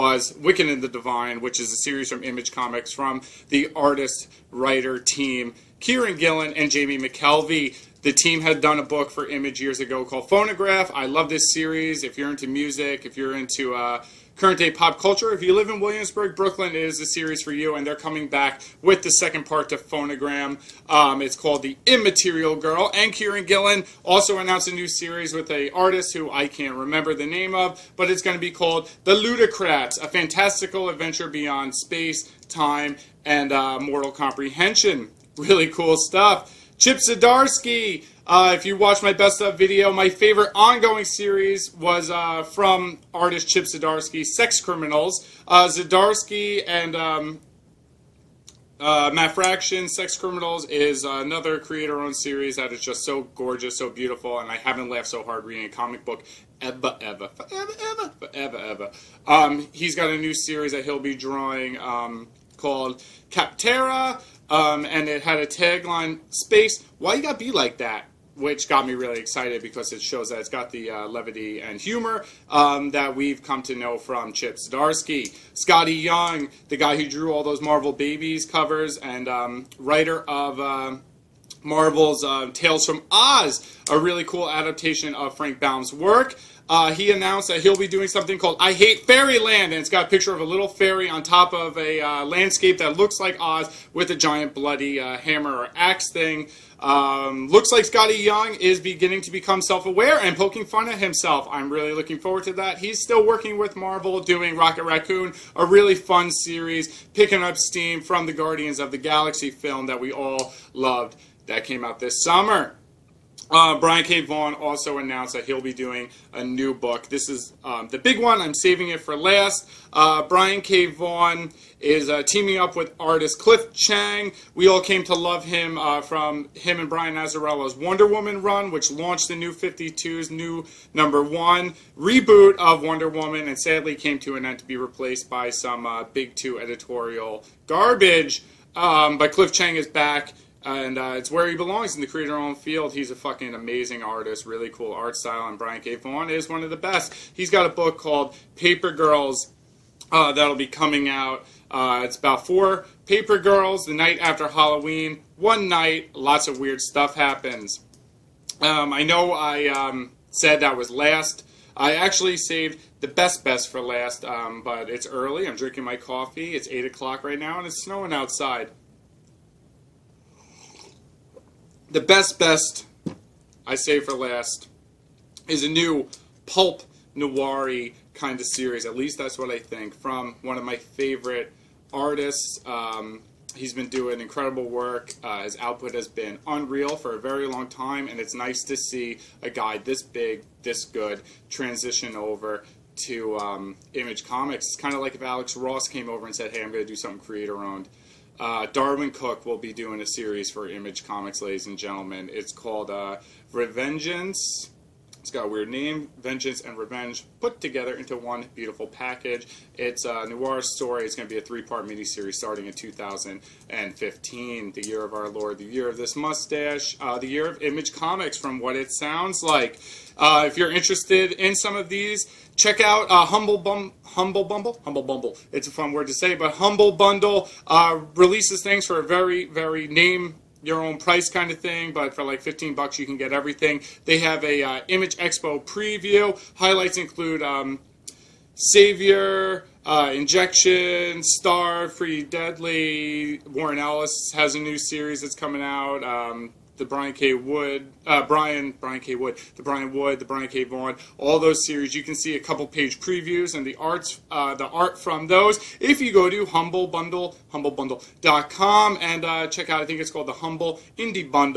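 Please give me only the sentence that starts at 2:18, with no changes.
Um, but Cliff Chiang is back and uh, it's where he belongs in the creator owned field.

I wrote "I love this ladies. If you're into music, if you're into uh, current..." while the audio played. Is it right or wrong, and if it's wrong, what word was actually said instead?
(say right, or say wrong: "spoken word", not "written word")
wrong: "series", not "ladies".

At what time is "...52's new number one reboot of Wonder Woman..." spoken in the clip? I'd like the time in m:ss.
2:09.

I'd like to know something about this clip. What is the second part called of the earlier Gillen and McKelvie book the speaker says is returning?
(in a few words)
The Immaterial Girl.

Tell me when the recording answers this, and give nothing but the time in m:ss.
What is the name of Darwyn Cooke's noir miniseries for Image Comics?
3:23.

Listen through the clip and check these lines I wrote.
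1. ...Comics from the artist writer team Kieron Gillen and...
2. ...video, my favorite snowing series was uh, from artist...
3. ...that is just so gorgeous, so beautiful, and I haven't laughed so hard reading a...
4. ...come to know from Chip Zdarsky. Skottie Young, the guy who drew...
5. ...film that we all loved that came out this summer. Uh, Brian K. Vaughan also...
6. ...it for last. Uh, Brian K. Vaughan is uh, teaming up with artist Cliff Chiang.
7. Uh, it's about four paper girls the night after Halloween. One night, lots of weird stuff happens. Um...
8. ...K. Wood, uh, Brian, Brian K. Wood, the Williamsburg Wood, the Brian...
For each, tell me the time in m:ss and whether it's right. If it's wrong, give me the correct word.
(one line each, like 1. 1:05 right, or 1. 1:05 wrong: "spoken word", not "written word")
1. 0:02 right
2. 0:39 wrong: "ongoing", not "snowing"
3. 0:52 right
4. 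1:13 right
5. 1:49 right
6. 1:58 right
7. 2:31 right
8. 4:07 wrong: "Brian", not "Williamsburg".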